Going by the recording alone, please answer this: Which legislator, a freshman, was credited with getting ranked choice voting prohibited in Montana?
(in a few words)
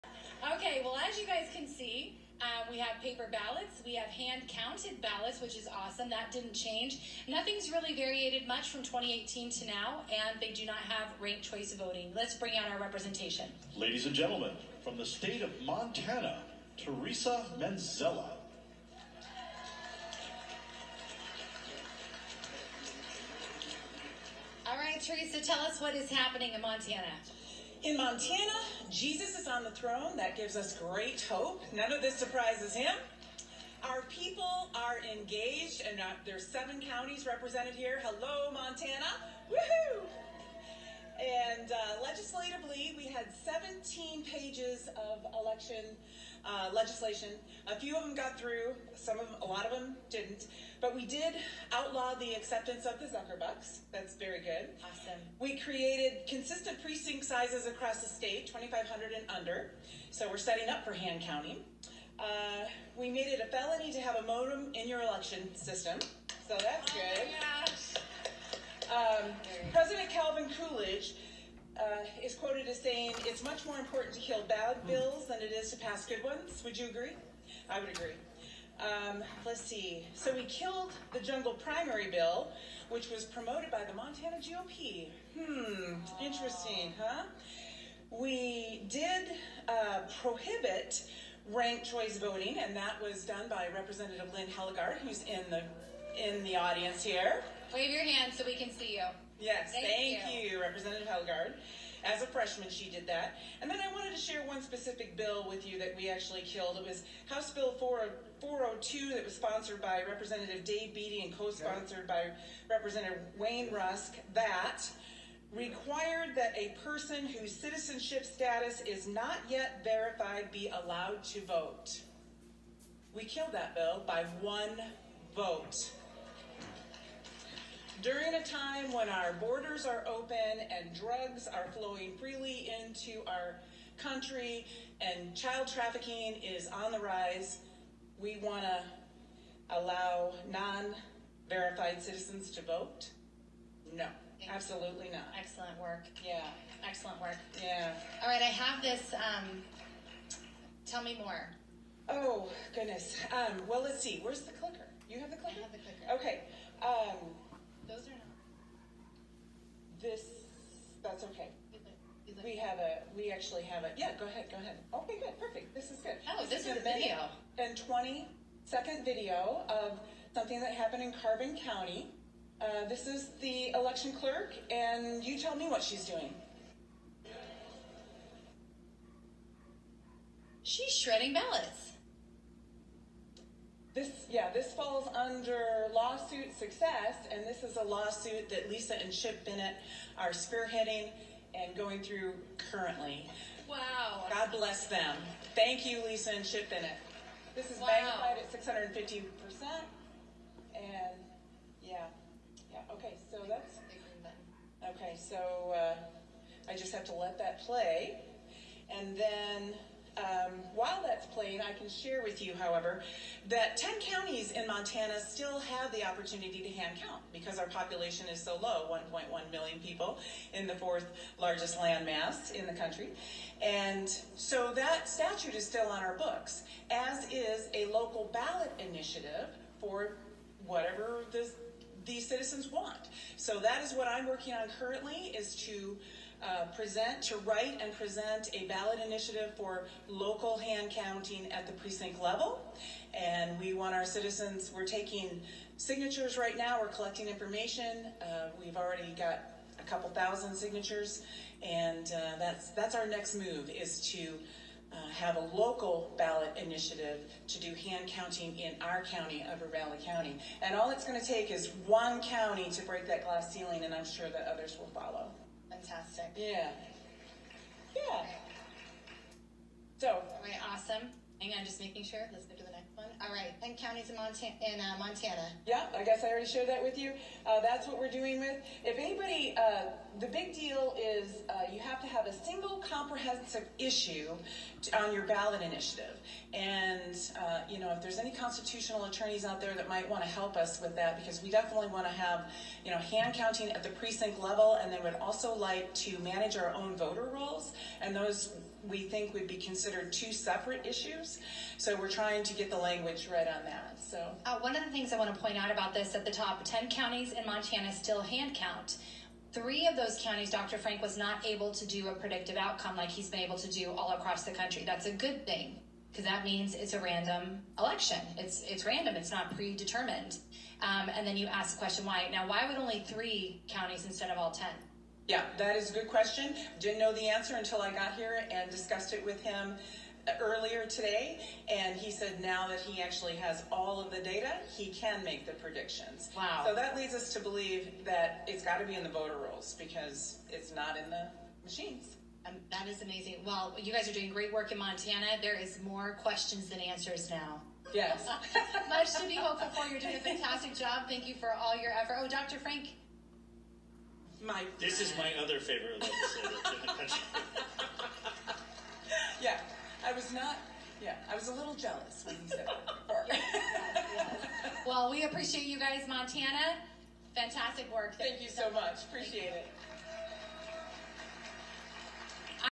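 Lynn Hellegaard.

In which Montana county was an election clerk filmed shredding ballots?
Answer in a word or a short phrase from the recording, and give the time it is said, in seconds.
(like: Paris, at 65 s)
Carbon County, at 171 s.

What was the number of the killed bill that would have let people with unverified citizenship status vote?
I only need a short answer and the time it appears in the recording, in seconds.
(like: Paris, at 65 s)
House Bill 402, at 107 s.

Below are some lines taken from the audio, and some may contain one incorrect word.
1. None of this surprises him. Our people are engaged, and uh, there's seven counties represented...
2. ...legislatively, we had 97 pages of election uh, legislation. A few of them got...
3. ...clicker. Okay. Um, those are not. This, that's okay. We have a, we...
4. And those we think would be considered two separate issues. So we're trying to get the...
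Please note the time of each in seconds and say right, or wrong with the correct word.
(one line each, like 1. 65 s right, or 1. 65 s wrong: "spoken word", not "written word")
1. 31 s right
2. 42 s wrong: "17", not "97"
3. 155 s right
4. 298 s right.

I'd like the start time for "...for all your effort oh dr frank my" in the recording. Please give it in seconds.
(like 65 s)
351 s.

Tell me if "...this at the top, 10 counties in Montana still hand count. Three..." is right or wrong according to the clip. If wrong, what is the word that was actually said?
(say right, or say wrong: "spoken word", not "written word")
right.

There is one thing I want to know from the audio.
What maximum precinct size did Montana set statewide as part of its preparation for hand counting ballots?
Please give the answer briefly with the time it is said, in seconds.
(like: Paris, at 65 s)
2,500, at 58 s.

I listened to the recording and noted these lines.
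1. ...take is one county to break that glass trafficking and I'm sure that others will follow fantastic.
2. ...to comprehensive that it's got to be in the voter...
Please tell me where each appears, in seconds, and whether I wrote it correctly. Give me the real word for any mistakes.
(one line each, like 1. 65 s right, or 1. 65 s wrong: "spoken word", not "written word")
1. 261 s wrong: "ceiling", not "trafficking"
2. 337 s wrong: "believe", not "comprehensive".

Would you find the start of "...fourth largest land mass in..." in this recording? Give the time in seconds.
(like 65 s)
220 s.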